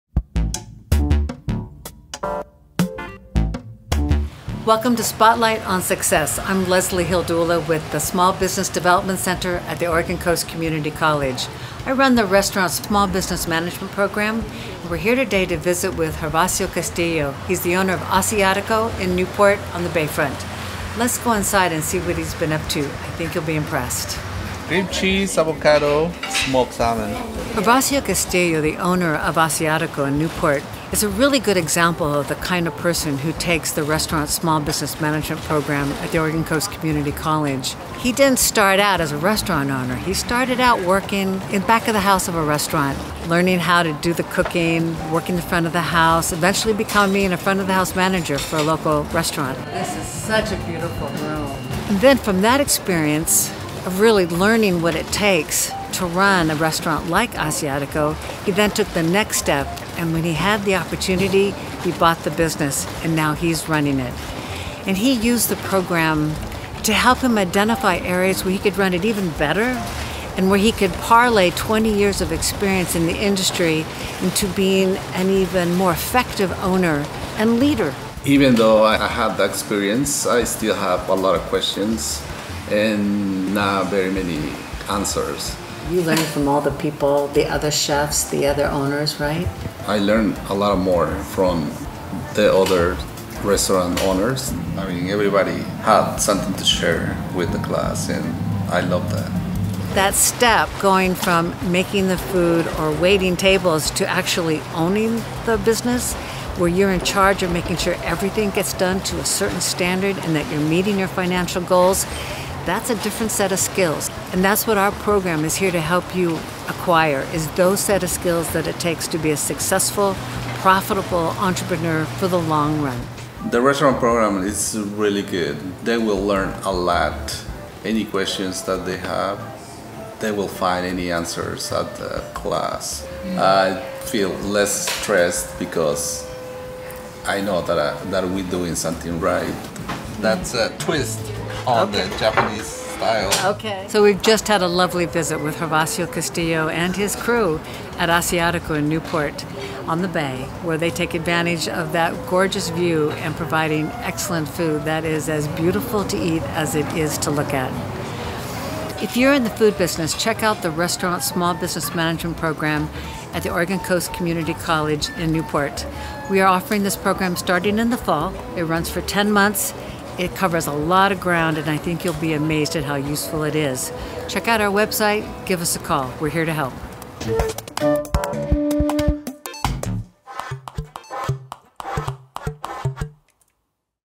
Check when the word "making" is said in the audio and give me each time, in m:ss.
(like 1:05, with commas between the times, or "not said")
1:41, 1:47.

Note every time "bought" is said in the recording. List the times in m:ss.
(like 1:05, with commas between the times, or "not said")
1:01.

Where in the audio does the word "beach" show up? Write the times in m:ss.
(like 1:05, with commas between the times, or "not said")
not said.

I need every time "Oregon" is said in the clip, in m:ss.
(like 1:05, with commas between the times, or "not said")
0:09, 0:36, 2:43.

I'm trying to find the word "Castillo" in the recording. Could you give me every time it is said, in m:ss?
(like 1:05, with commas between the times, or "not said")
0:16, 0:28, 2:26.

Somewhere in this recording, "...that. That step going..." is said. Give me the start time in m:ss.
1:39.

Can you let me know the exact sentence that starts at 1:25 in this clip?
You learned from all the people, the other chefs, the other owners, right?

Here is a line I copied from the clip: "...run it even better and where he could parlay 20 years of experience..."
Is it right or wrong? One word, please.
right.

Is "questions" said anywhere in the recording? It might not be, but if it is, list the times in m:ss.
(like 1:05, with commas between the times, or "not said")
1:21, 2:08.